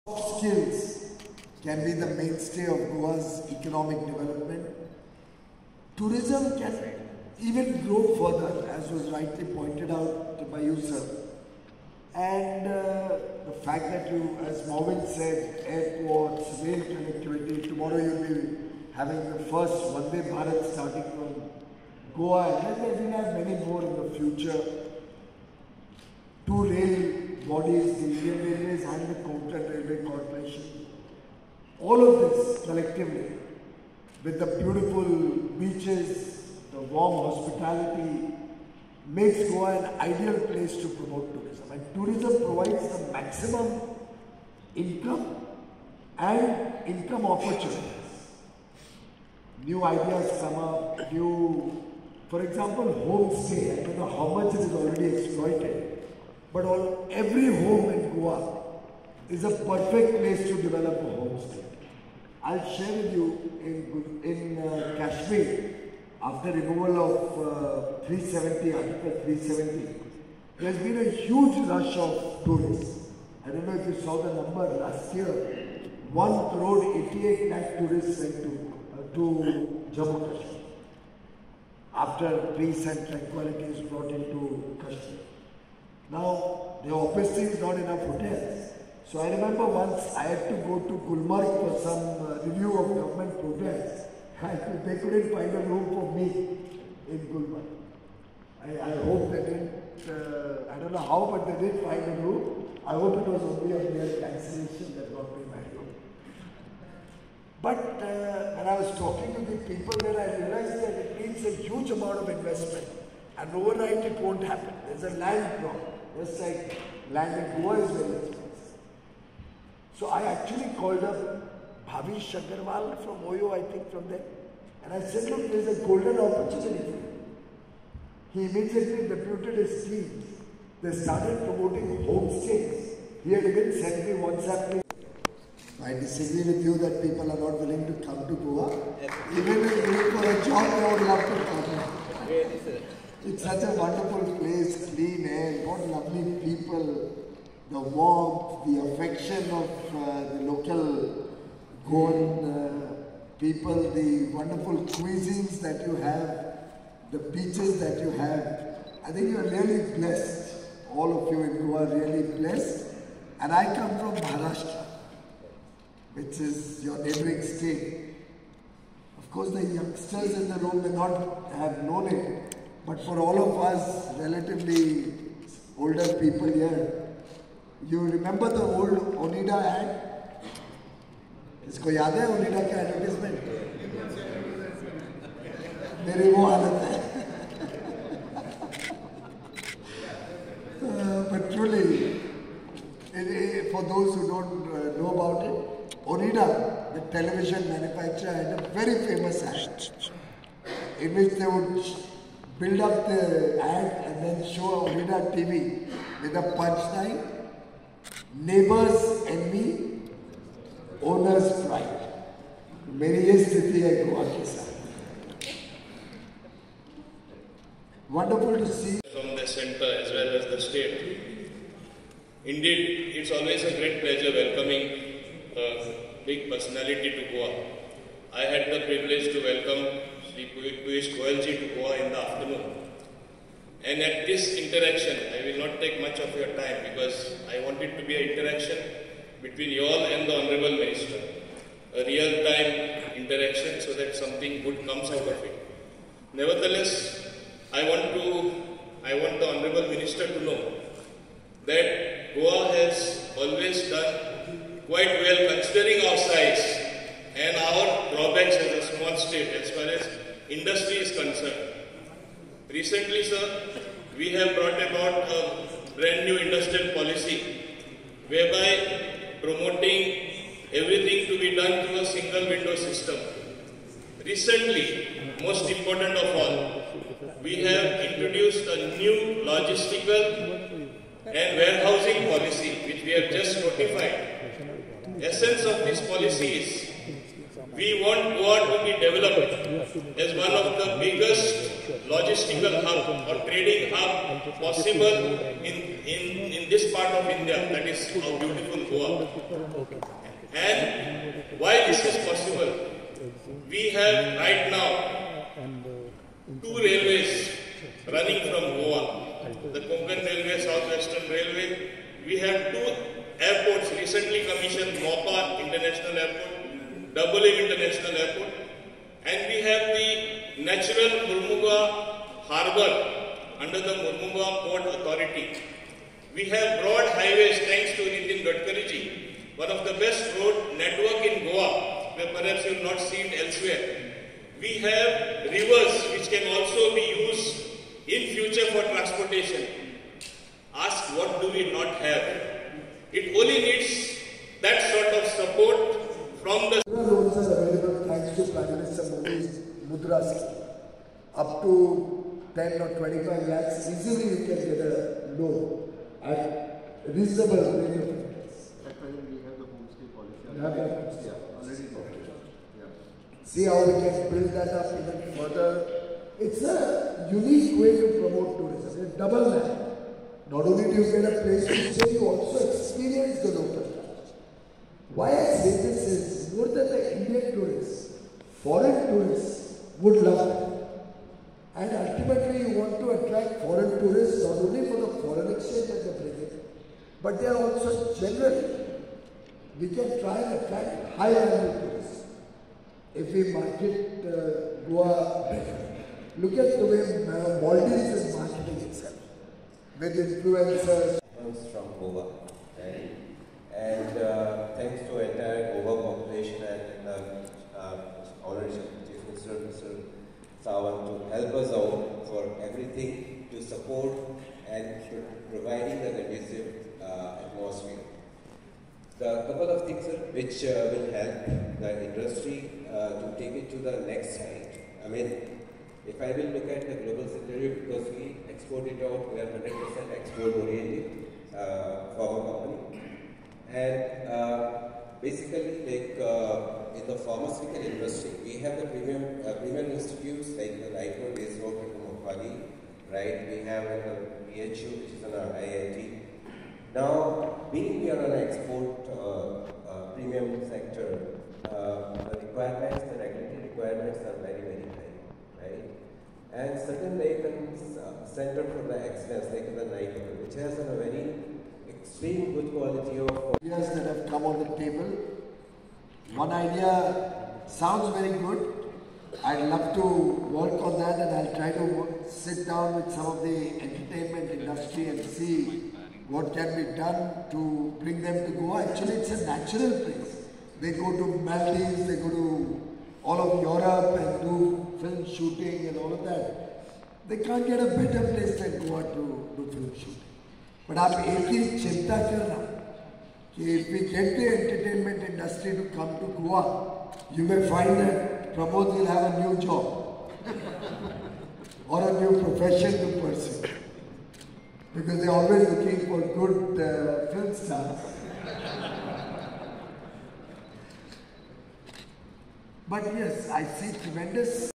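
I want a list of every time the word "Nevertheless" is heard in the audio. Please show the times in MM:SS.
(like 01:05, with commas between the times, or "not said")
04:06.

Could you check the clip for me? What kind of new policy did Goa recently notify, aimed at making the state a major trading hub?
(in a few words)
logistical and warehousing policy.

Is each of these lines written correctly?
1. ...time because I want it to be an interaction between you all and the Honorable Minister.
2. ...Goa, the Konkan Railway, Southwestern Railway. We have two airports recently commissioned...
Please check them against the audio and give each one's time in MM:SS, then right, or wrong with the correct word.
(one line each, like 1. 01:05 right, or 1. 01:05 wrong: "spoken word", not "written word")
1. 03:56 right
2. 05:08 right.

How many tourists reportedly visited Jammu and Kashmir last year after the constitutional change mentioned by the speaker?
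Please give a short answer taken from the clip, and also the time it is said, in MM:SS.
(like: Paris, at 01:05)
1 crore 88 lakh, at 01:15.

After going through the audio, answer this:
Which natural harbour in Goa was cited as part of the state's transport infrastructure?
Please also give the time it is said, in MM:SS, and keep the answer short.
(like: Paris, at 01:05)
Mormugao Harbour, at 05:21.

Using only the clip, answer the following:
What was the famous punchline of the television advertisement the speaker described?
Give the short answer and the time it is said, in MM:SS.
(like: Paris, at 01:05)
neighbors envy, owners pride, at 03:28.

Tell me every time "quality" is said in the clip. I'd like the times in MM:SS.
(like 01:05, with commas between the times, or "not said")
07:42.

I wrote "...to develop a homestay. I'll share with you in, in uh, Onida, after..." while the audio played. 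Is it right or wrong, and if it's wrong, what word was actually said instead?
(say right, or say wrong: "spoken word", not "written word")
wrong: "Kashmir", not "Onida".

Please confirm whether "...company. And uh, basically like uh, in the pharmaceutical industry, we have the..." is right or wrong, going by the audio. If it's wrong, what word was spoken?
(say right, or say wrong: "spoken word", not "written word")
right.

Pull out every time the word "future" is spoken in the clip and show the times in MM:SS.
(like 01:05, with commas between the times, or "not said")
00:24, 05:38.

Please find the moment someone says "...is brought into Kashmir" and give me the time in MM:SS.
01:23.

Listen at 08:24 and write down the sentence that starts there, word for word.
Because they're always looking for good uh, film stars.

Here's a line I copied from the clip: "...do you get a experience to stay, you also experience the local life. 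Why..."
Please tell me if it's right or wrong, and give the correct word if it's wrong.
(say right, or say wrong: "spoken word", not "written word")
wrong: "place", not "experience".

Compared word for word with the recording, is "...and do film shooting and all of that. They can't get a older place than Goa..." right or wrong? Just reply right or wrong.
wrong.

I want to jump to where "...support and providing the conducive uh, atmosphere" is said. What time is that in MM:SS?
06:53.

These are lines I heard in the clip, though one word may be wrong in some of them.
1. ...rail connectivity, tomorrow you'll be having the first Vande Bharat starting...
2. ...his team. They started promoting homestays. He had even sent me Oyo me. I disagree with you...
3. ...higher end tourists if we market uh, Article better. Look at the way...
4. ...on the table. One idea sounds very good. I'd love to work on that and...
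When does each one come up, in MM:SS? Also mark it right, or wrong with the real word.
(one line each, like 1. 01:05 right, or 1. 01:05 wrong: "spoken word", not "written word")
1. 00:16 right
2. 02:09 wrong: "WhatsApp", not "Oyo"
3. 06:31 wrong: "Goa", not "Article"
4. 07:44 right.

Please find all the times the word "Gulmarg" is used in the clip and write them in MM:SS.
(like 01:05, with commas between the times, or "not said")
01:31, 01:37.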